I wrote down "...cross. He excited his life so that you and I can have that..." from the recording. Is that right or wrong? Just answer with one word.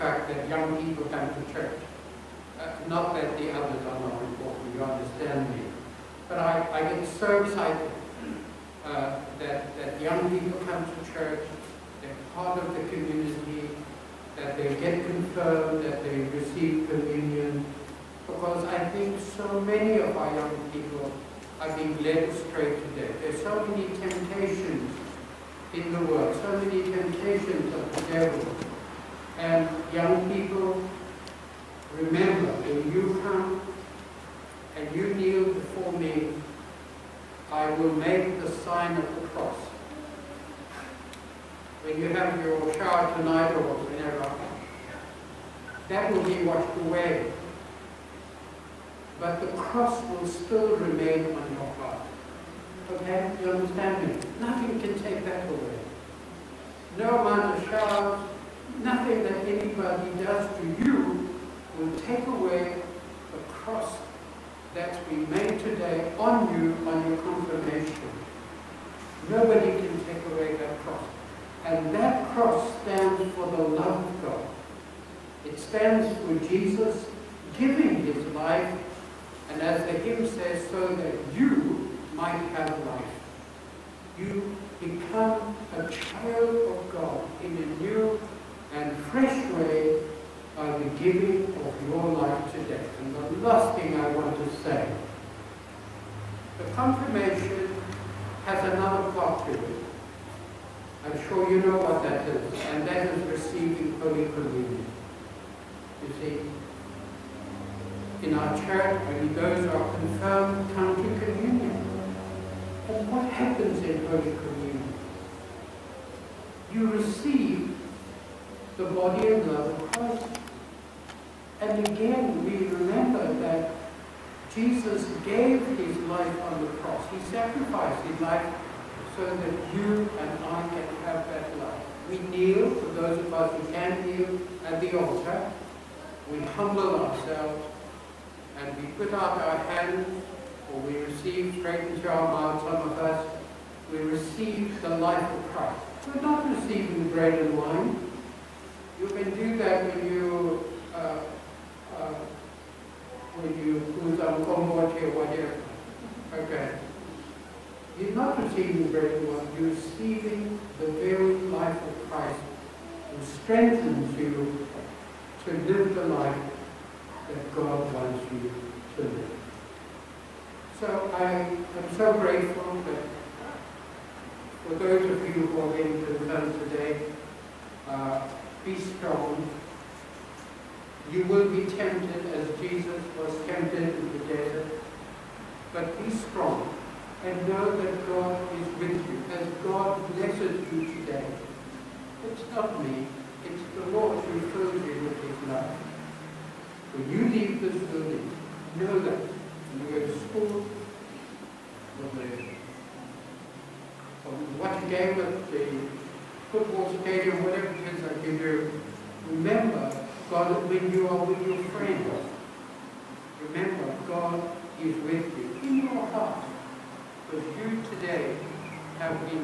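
wrong.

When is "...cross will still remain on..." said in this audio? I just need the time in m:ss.
0:49.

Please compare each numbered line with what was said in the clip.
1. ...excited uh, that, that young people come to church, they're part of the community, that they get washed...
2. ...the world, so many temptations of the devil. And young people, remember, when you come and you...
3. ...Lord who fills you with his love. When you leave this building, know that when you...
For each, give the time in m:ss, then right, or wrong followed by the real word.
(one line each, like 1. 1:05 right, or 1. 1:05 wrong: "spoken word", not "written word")
1. 0:07 wrong: "confirmed", not "washed"
2. 0:25 right
3. 3:13 right.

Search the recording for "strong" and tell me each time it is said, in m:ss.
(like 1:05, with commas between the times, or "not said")
2:58, 3:06.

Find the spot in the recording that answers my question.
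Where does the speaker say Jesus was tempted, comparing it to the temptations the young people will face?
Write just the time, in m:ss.
3:04.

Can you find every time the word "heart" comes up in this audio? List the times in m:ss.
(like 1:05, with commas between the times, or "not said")
0:51, 3:36.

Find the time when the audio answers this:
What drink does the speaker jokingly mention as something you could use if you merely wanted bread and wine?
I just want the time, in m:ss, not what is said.
2:34.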